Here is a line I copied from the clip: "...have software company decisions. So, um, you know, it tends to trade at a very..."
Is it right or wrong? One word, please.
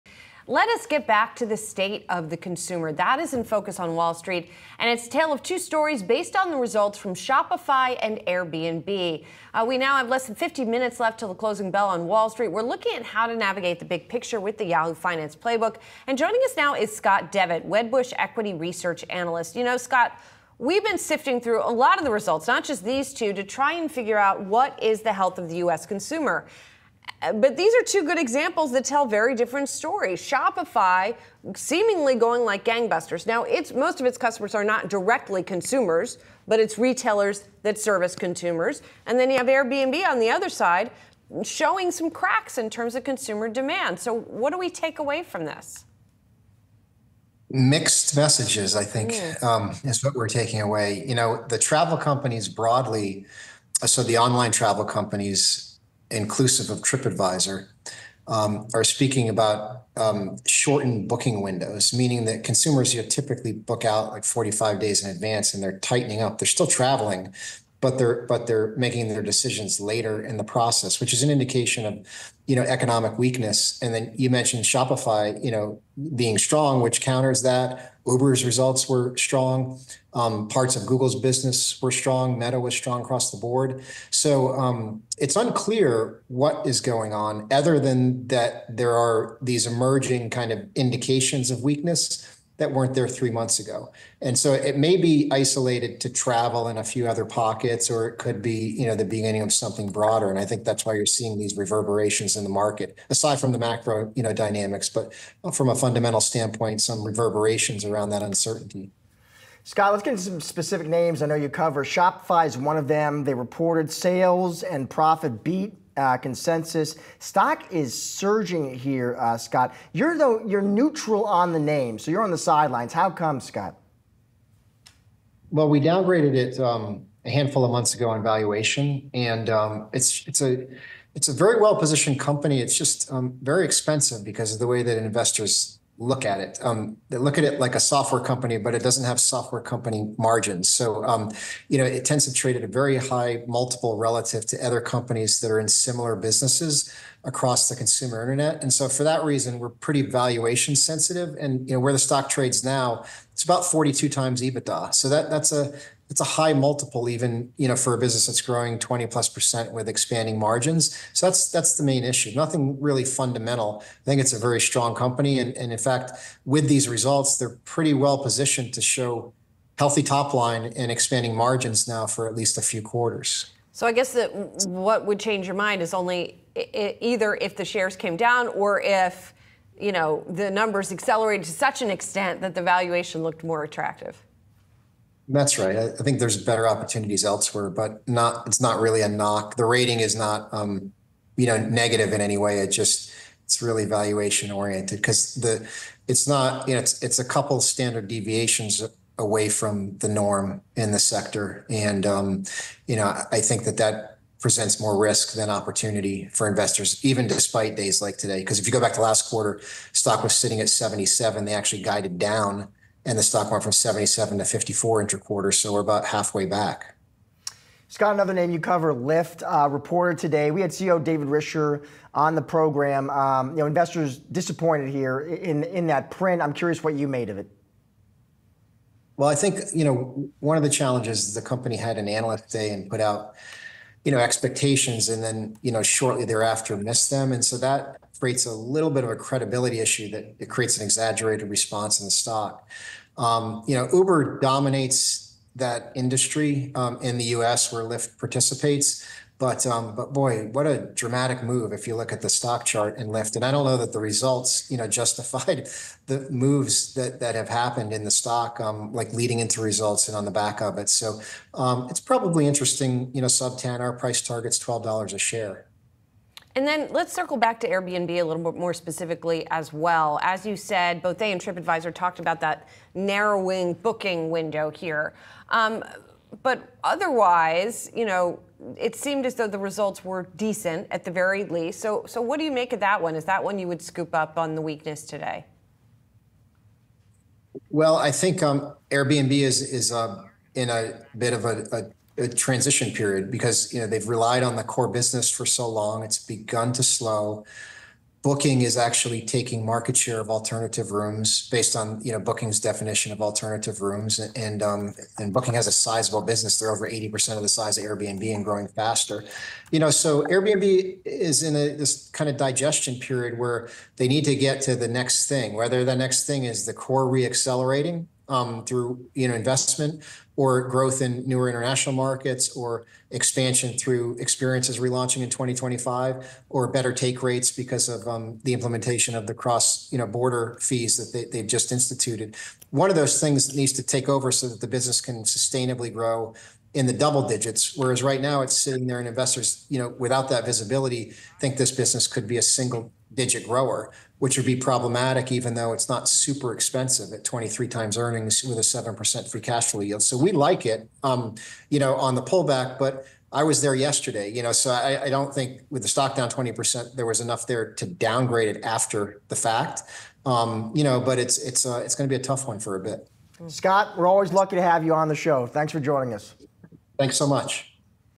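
wrong.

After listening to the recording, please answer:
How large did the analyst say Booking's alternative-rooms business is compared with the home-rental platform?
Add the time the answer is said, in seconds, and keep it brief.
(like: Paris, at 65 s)
over 80%, at 306 s.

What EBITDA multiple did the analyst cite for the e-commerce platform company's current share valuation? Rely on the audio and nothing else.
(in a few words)
42 times.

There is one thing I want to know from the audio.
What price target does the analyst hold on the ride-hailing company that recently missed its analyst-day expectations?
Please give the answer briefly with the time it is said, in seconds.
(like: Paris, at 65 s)
$12 a share, at 264 s.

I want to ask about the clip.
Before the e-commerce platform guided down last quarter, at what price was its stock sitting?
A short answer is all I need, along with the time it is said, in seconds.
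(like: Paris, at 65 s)
77, at 210 s.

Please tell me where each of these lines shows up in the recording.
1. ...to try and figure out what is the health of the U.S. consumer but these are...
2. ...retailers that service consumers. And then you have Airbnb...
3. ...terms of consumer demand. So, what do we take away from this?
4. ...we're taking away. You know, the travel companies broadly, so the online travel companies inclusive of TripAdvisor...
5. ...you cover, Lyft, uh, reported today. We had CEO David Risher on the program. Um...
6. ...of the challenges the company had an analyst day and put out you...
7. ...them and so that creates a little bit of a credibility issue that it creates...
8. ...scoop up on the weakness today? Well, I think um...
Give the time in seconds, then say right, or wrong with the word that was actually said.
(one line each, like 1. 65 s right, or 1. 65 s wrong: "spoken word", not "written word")
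1. 23 s right
2. 36 s right
3. 42 s right
4. 50 s right
5. 218 s right
6. 230 s right
7. 237 s right
8. 283 s right.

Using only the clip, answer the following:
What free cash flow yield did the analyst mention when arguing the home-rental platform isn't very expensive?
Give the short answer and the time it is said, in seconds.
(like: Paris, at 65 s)
7%, at 348 s.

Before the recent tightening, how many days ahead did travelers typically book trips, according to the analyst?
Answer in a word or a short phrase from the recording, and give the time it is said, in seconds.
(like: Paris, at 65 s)
45 days, at 64 s.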